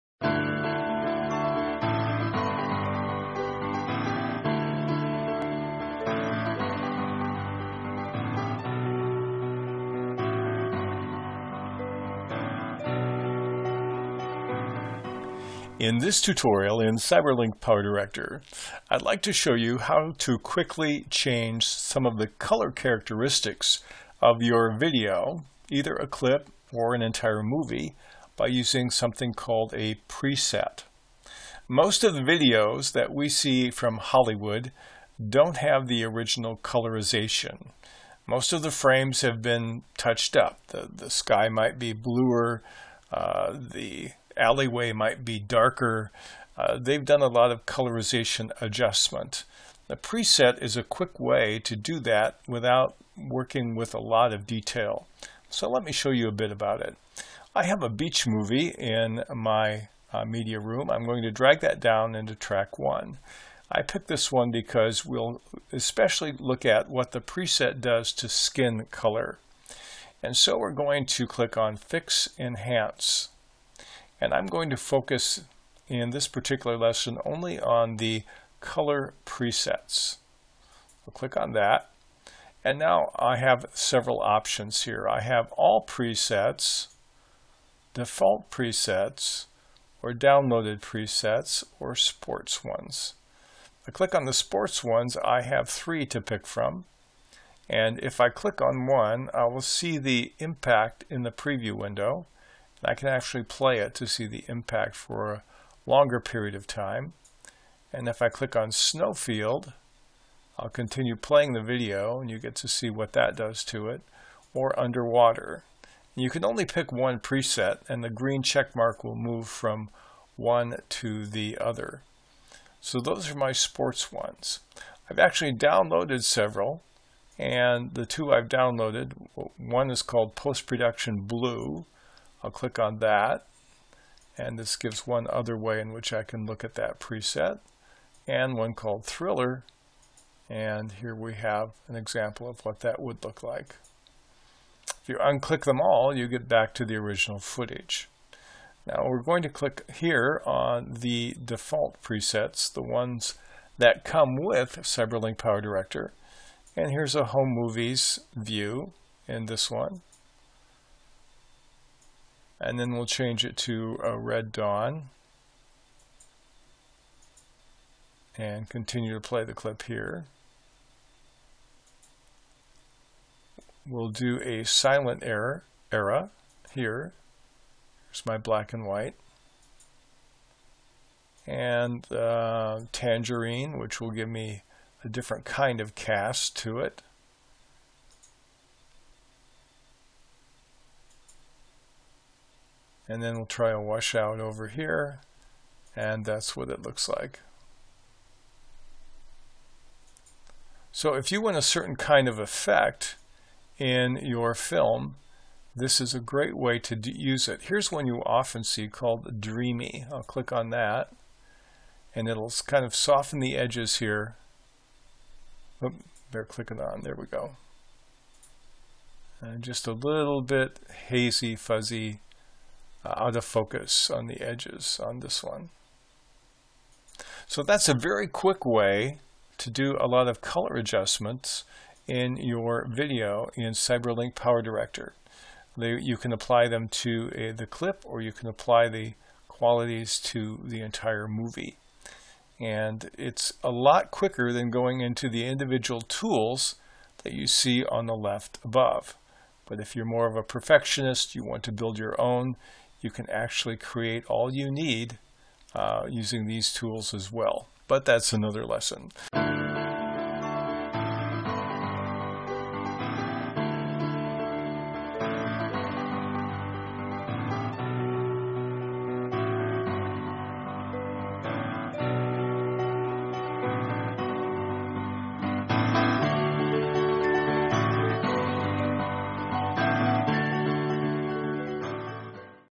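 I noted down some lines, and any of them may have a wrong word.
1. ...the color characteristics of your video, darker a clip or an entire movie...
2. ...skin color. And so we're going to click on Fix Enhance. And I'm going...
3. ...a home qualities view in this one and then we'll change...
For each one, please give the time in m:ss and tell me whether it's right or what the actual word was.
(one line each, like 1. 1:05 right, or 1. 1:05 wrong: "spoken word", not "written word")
1. 0:22 wrong: "either", not "darker"
2. 1:08 right
3. 2:37 wrong: "movies", not "qualities".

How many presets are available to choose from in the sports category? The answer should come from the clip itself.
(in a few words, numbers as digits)
3.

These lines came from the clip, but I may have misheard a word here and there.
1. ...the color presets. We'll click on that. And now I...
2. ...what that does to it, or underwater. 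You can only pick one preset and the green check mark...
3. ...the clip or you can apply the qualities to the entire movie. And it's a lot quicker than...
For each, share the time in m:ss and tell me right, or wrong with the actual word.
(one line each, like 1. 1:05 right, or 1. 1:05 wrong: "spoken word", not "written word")
1. 1:17 right
2. 1:52 right
3. 3:57 right.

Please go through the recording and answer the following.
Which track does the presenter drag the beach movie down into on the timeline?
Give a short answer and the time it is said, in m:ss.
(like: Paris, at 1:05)
Track 1, at 1:02.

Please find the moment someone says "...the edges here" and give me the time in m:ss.
3:33.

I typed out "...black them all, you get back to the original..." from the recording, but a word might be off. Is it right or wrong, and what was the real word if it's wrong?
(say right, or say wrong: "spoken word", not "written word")
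wrong: "unclick", not "black".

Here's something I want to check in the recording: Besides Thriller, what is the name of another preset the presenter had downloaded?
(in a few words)
Post Production Blue.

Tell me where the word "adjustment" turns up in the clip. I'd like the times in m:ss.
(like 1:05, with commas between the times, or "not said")
0:48, 3:50.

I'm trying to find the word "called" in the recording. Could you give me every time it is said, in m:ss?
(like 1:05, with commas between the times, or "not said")
0:29, 2:10, 2:18, 3:28.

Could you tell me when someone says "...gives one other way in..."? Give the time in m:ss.
2:14.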